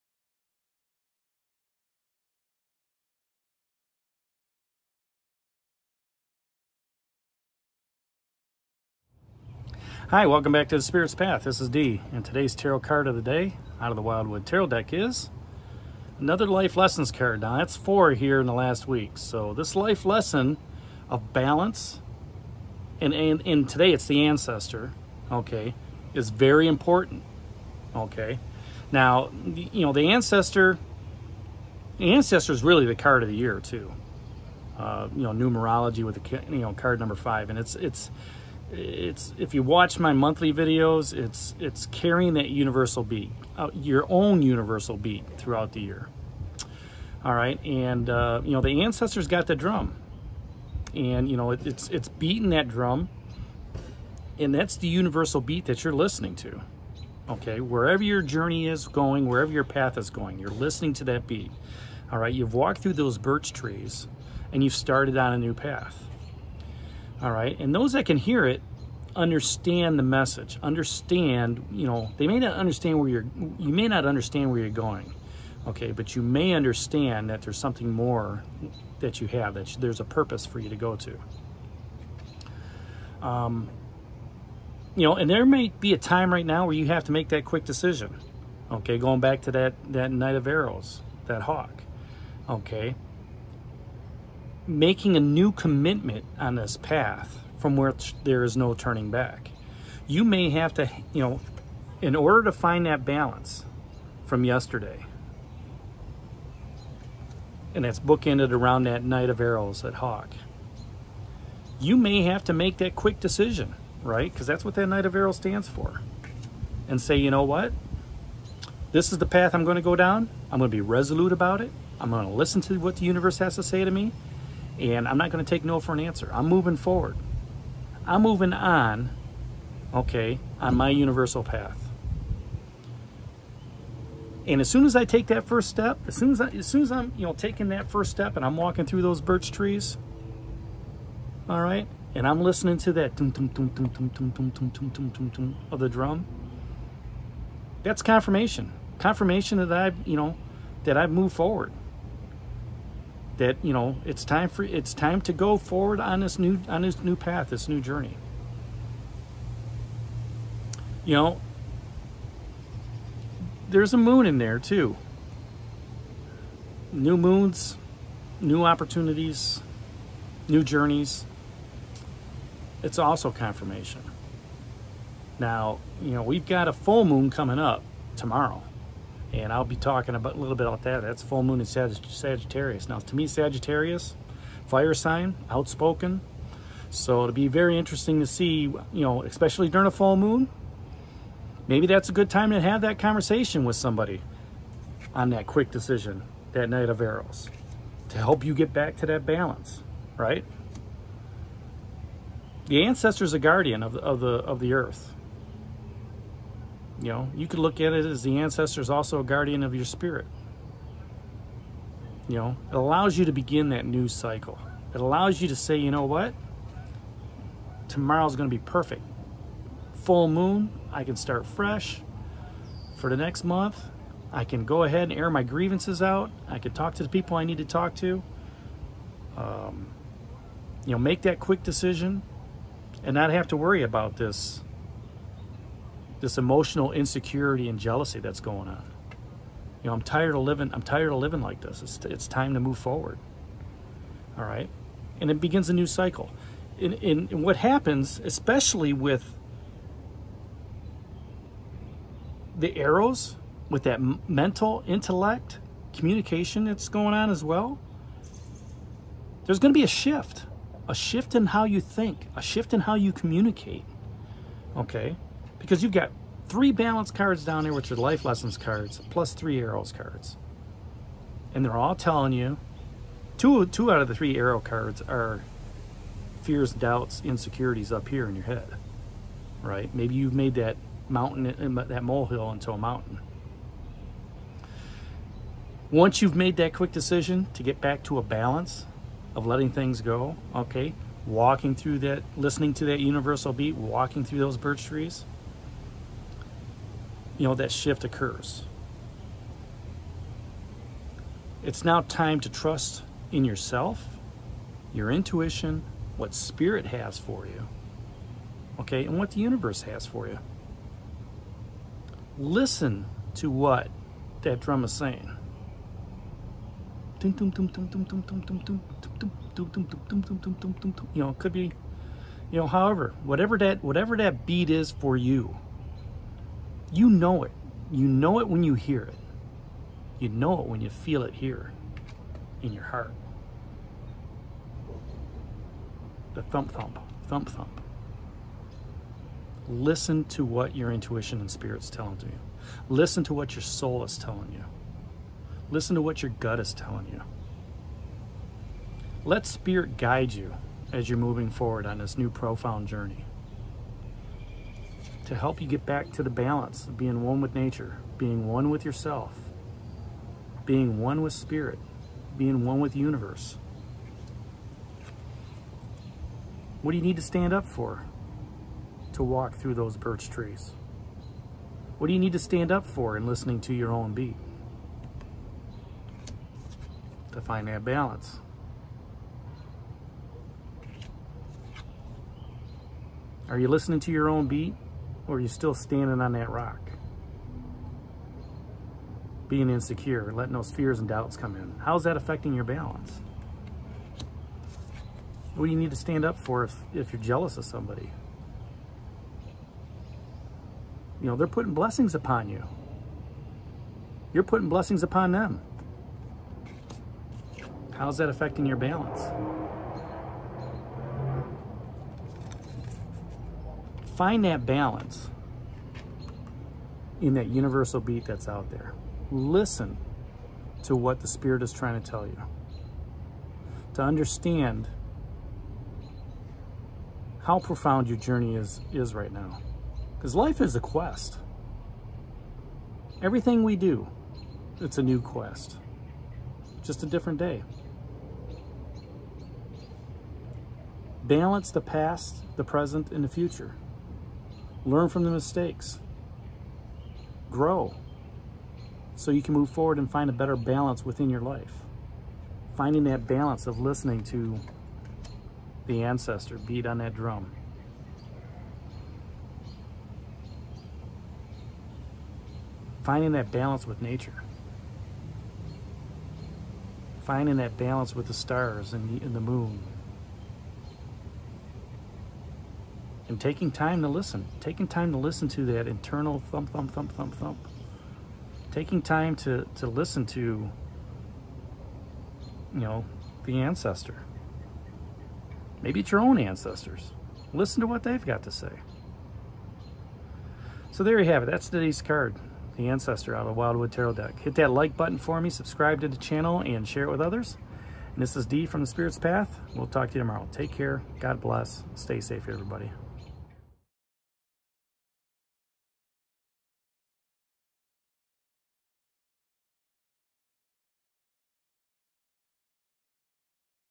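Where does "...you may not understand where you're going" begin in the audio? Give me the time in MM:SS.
01:13.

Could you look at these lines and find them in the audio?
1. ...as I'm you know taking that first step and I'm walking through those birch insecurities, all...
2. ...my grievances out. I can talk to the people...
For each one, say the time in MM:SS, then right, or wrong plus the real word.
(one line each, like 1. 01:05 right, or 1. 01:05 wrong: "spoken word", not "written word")
1. 02:16 wrong: "trees", not "insecurities"
2. 03:45 right.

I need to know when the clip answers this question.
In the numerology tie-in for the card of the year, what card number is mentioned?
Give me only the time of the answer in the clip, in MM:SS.
00:37.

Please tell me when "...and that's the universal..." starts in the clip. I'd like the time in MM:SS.
00:54.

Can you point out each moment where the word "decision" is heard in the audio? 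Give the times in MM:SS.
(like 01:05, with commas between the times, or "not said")
01:27, 01:53, 03:15, 03:51, 04:46.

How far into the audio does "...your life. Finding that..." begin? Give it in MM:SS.
07:31.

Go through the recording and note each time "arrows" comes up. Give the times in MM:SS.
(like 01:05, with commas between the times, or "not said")
01:30, 01:49, 01:55, 03:16, 04:12, 04:29, 04:34.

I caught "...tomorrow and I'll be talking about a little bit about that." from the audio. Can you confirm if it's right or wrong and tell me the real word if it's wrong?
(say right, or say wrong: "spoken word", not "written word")
right.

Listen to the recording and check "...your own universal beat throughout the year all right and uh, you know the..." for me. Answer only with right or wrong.
right.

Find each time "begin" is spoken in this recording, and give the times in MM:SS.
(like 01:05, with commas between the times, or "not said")
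03:33, 04:05.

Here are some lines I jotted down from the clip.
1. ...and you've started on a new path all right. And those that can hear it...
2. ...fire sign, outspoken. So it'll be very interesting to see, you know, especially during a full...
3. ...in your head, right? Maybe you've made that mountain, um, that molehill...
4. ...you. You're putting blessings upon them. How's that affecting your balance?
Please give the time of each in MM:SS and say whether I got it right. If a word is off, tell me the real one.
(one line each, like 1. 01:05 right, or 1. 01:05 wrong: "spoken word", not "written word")
1. 01:04 right
2. 03:04 right
3. 04:38 right
4. 06:42 right.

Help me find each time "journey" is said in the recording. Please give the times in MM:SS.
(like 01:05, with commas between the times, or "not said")
00:58, 02:37, 02:50, 05:52, 07:08.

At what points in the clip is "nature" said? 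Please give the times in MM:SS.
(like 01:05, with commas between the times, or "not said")
05:57, 07:44.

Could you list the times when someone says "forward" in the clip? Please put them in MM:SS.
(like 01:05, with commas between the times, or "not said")
02:06, 02:31, 02:35, 04:02, 05:51, 07:29.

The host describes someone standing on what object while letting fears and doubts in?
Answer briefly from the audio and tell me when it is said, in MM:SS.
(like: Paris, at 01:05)
rock, at 06:26.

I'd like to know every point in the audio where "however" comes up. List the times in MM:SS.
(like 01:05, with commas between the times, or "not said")
05:22.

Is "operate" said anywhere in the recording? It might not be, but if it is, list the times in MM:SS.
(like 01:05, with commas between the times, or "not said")
not said.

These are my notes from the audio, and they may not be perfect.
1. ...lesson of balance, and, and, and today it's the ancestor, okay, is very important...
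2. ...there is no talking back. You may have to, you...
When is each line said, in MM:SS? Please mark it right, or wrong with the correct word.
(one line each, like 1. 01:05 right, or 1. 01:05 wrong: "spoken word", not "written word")
1. 00:20 right
2. 01:38 wrong: "turning", not "talking".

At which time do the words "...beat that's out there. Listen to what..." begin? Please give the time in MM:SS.
06:57.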